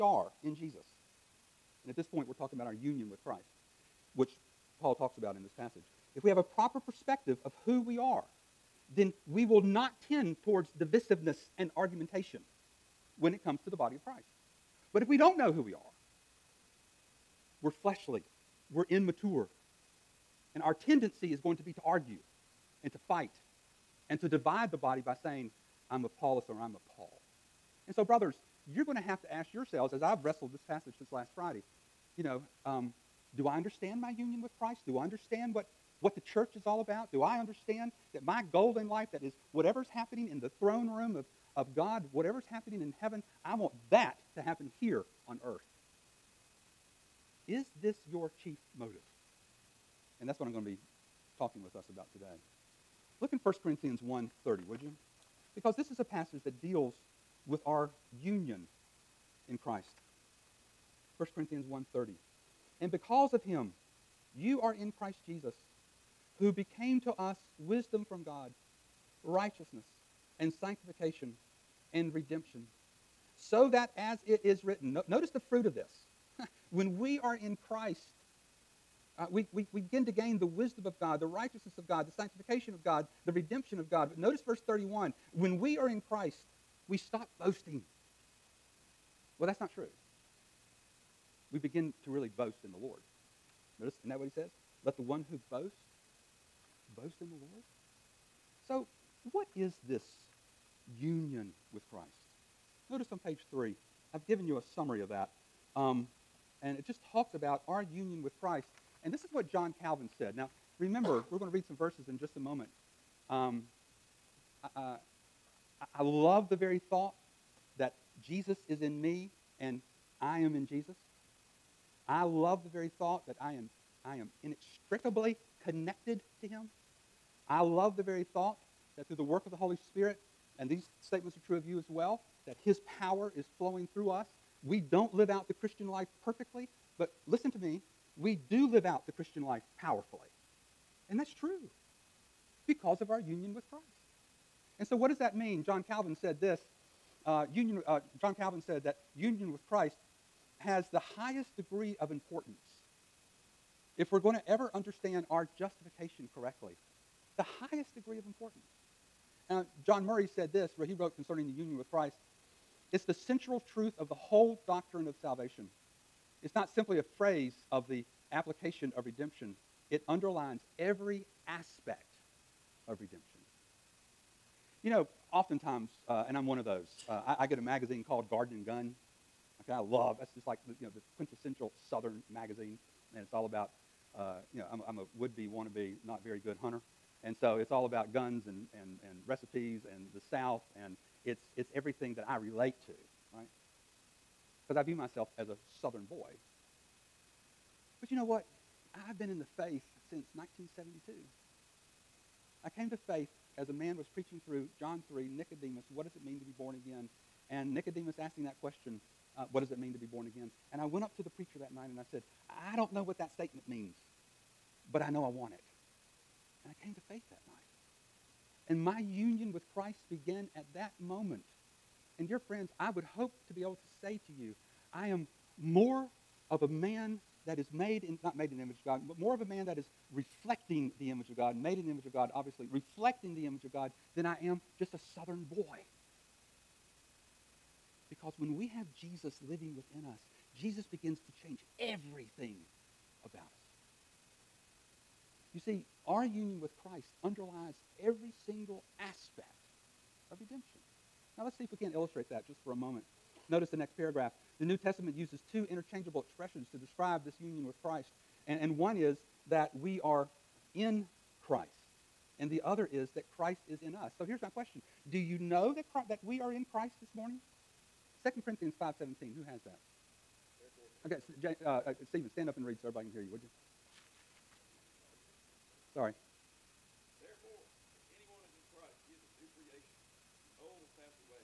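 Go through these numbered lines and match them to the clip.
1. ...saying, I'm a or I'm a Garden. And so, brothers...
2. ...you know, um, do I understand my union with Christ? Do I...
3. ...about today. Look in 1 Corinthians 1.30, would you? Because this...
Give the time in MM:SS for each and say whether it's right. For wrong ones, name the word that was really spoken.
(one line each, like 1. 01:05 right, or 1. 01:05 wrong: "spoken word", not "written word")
1. 00:25 wrong: "Paul", not "Garden"
2. 00:32 right
3. 00:51 right.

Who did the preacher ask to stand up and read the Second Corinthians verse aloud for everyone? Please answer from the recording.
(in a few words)
Stephen.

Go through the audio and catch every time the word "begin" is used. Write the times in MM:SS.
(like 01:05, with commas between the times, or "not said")
01:19, 01:31, 04:00.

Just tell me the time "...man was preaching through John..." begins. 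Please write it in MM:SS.
03:23.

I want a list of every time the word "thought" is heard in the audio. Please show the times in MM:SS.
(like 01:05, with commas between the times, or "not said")
01:56, 02:02, 02:08.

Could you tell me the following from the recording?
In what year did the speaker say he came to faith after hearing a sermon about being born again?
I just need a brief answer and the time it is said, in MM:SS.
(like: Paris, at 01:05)
1972, at 03:20.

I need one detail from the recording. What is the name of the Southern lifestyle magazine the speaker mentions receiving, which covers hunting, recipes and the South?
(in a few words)
Garden and Gun.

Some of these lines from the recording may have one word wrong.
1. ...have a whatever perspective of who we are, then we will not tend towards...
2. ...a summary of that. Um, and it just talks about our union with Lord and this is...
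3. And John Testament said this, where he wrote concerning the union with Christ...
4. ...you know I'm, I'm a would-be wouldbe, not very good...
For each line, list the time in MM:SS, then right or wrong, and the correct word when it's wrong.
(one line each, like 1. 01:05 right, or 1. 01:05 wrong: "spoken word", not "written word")
1. 00:06 wrong: "proper", not "whatever"
2. 01:44 wrong: "Christ", not "Lord"
3. 02:39 wrong: "Murray", not "Testament"
4. 03:04 wrong: "wannabe", not "wouldbe".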